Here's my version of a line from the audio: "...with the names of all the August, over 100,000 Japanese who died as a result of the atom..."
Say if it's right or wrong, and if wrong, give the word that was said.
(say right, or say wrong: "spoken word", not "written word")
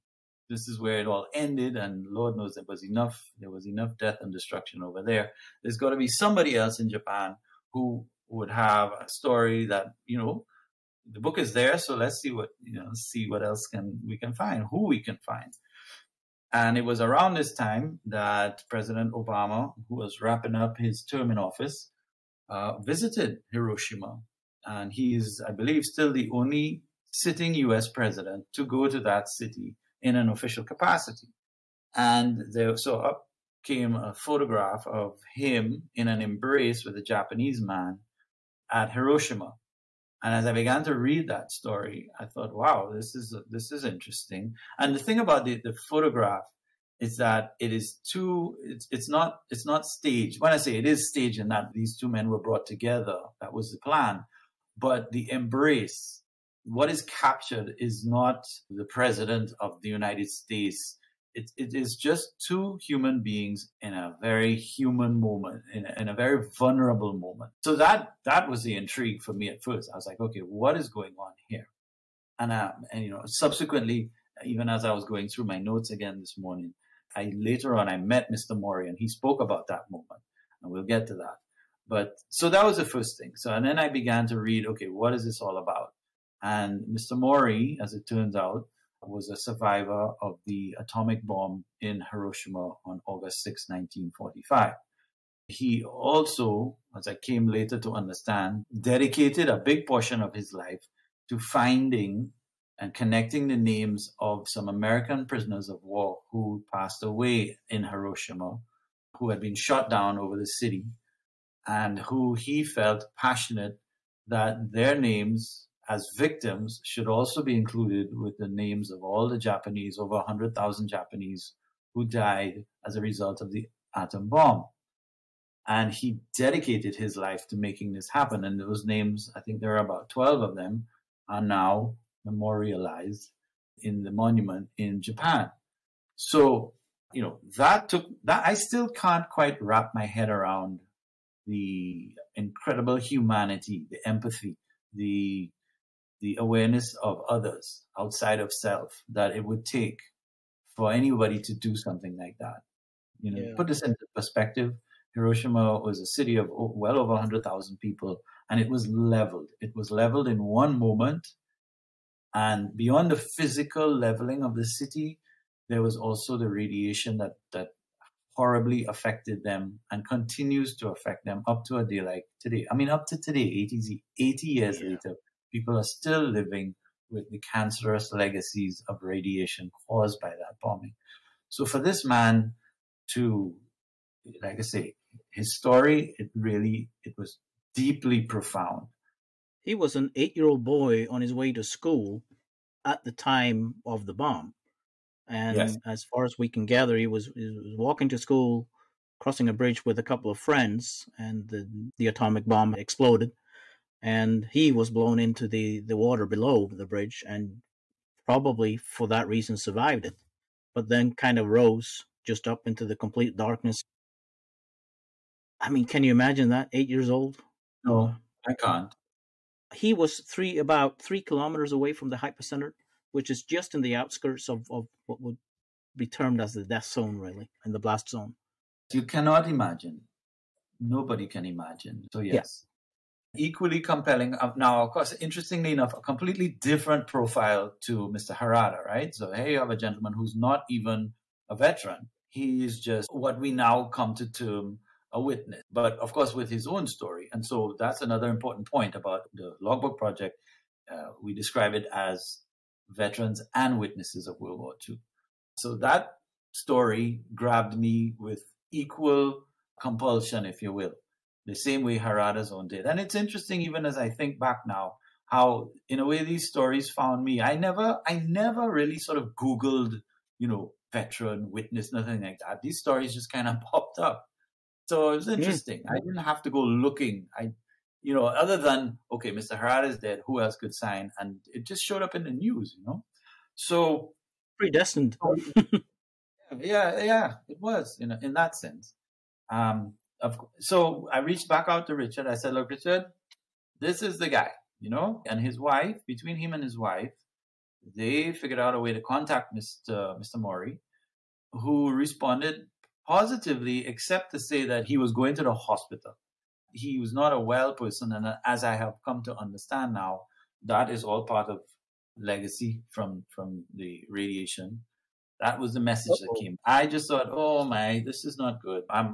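wrong: "Japanese", not "August".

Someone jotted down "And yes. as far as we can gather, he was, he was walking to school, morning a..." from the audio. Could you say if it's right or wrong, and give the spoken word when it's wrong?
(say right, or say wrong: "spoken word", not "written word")
wrong: "crossing", not "morning".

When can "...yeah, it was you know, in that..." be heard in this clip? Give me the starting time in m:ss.
4:47.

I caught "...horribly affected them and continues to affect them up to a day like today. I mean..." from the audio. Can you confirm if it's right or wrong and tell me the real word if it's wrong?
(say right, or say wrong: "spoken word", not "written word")
right.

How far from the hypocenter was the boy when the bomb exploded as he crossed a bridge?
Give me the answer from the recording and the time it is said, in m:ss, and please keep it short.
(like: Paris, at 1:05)
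3 kilometers, at 3:41.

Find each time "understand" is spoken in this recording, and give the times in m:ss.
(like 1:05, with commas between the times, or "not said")
1:37, 5:09.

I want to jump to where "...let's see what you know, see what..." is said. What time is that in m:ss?
0:11.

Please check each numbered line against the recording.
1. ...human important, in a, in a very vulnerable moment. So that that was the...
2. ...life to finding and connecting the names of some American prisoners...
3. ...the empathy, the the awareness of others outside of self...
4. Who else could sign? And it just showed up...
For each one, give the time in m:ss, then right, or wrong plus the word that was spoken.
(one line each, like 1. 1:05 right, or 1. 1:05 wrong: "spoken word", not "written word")
1. 1:04 wrong: "moment", not "important"
2. 1:40 right
3. 2:23 right
4. 4:40 right.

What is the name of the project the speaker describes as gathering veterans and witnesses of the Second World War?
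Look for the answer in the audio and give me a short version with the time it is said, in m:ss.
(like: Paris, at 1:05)
Logbook Project, at 4:09.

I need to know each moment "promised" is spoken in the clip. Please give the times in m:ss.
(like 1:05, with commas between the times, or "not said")
not said.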